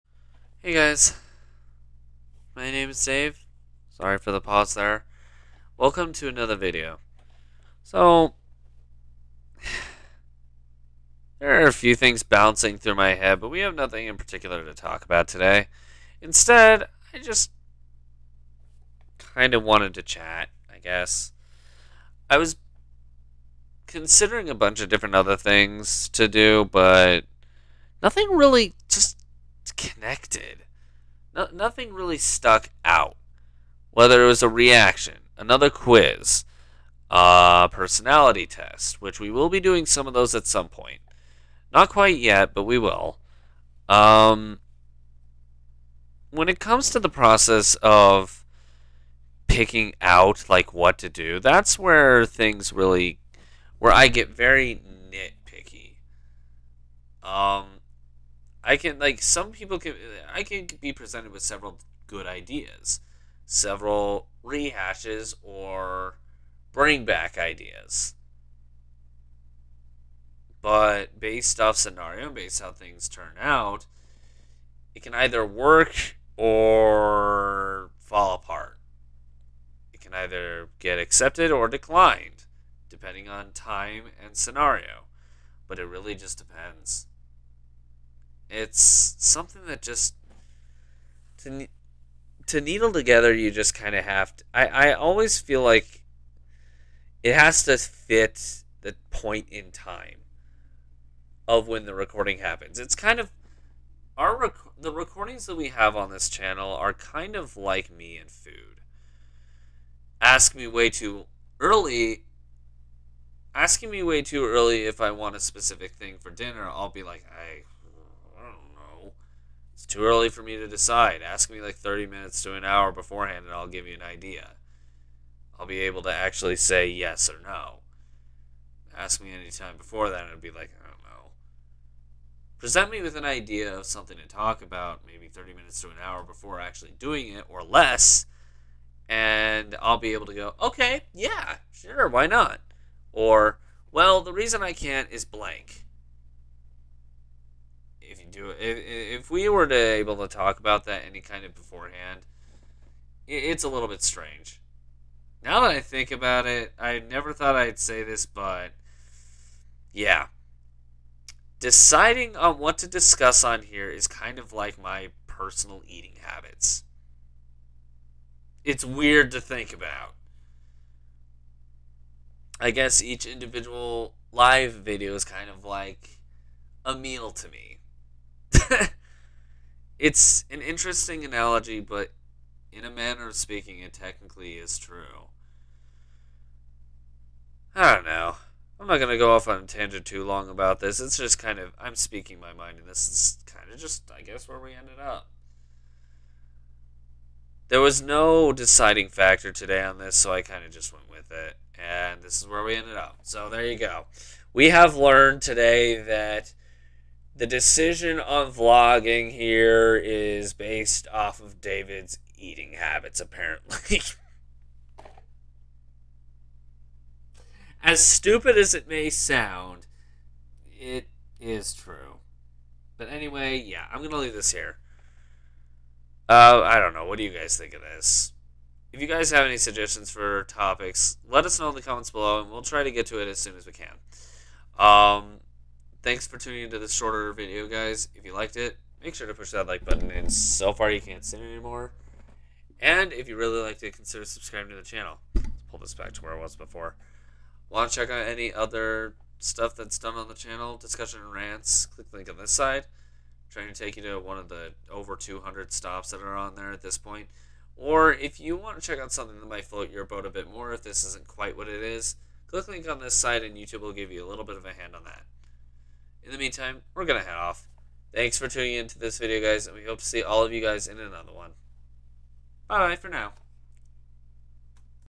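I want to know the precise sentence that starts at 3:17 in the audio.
There was no deciding factor today on this, so I kind of just went with it.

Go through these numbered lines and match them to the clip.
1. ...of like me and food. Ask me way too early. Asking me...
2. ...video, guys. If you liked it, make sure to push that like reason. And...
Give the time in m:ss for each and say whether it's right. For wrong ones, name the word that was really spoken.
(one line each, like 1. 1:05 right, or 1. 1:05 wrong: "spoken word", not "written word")
1. 1:47 right
2. 3:57 wrong: "button", not "reason".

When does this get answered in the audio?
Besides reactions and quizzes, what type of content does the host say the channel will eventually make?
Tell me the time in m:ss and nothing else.
0:37.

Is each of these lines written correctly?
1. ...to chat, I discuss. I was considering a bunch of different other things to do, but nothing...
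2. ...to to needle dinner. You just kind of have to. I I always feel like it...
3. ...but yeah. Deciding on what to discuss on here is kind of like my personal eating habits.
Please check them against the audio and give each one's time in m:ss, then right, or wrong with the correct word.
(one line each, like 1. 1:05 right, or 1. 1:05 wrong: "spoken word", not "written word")
1. 0:19 wrong: "guess", not "discuss"
2. 1:31 wrong: "together", not "dinner"
3. 2:38 right.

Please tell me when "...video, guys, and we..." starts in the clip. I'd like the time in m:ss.
4:29.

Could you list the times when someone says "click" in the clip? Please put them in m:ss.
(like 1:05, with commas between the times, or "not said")
4:11, 4:22.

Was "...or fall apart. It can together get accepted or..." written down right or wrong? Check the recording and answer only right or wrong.
wrong.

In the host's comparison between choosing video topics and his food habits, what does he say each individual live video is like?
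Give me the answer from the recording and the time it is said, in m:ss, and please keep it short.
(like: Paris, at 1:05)
a meal, at 2:56.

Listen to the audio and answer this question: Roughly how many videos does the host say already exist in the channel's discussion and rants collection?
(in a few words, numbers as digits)
over 200.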